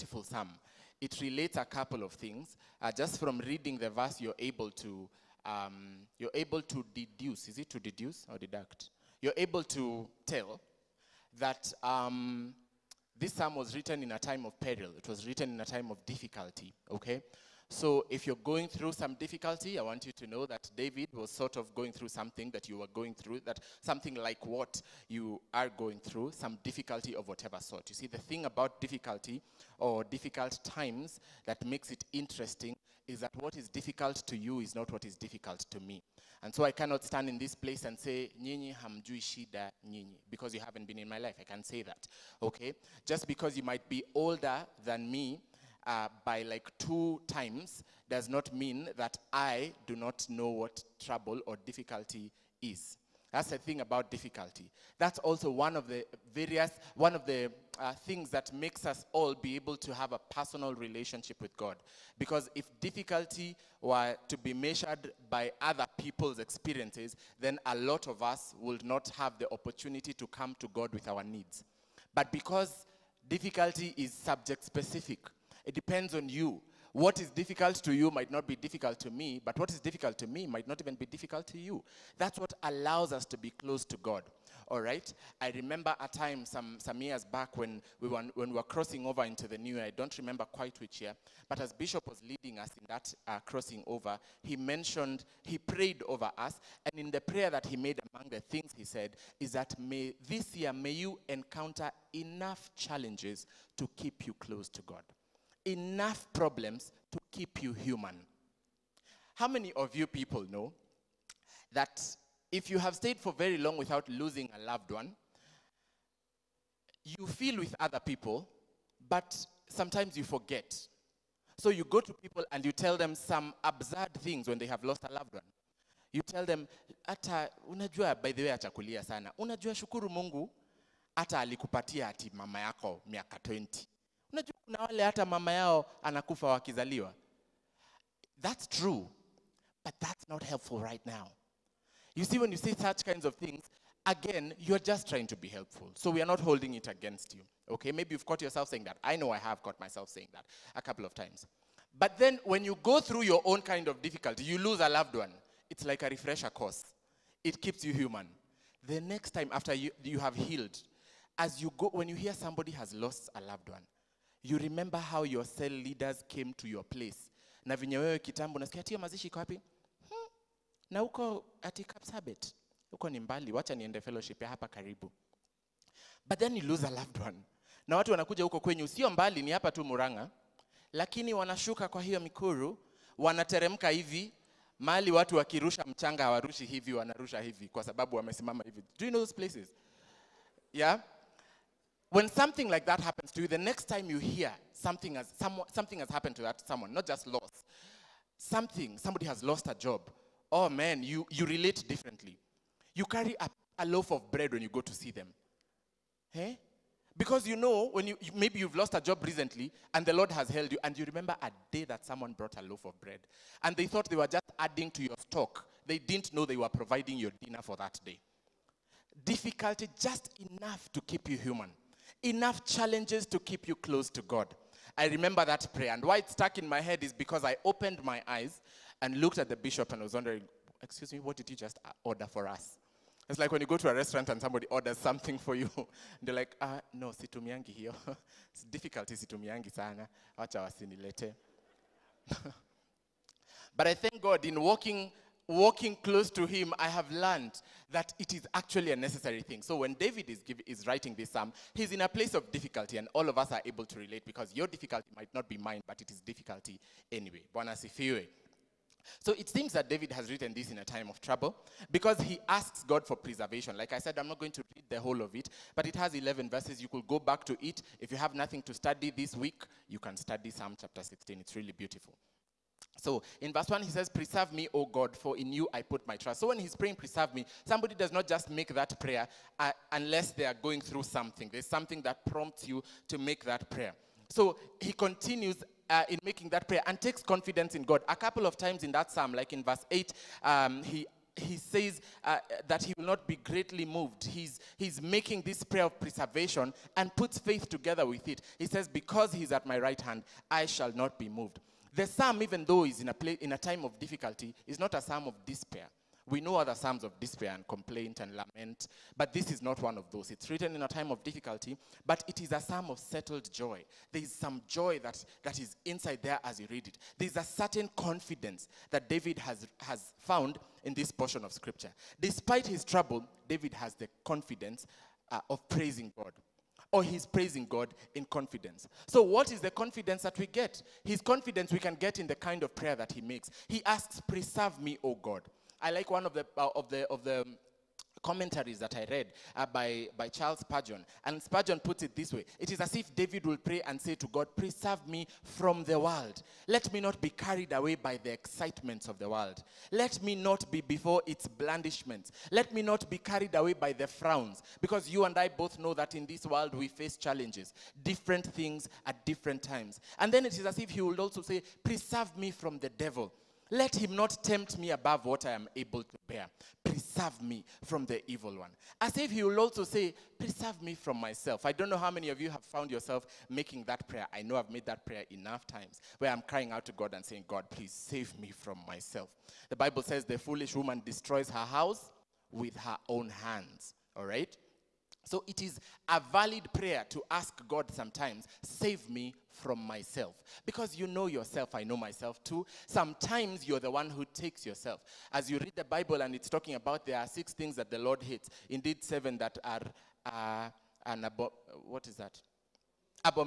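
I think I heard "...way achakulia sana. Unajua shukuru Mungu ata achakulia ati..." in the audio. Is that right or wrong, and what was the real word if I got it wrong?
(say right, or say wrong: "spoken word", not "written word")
wrong: "alikupatia", not "achakulia".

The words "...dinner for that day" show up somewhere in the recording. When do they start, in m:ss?
3:37.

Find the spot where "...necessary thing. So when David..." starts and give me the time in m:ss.
4:08.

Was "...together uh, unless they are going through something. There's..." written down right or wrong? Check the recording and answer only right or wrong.
wrong.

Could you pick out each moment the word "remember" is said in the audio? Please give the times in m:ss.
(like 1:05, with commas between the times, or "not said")
1:25, 1:30, 2:44, 3:31, 3:45.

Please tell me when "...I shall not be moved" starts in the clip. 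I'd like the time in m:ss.
5:00.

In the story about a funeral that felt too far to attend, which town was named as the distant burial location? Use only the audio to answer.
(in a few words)
Kapsabet.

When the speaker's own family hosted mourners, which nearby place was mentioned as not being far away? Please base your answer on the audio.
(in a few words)
Murang'a.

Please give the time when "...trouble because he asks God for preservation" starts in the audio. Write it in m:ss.
4:21.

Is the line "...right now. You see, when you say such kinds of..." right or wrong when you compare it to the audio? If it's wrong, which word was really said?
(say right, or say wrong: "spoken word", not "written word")
right.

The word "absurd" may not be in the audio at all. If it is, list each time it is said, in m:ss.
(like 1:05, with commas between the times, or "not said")
2:03.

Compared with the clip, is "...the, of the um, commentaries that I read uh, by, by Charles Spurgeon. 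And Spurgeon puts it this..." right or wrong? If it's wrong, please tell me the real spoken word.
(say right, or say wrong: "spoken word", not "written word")
right.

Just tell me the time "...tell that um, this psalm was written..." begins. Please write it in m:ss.
0:10.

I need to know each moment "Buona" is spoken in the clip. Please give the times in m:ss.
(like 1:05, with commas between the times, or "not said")
4:17.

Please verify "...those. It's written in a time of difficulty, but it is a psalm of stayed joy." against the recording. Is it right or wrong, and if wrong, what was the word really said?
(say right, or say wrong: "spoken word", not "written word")
wrong: "settled", not "stayed".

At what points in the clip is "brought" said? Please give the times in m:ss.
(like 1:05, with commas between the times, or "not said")
3:32.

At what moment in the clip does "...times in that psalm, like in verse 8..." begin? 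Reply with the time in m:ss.
4:48.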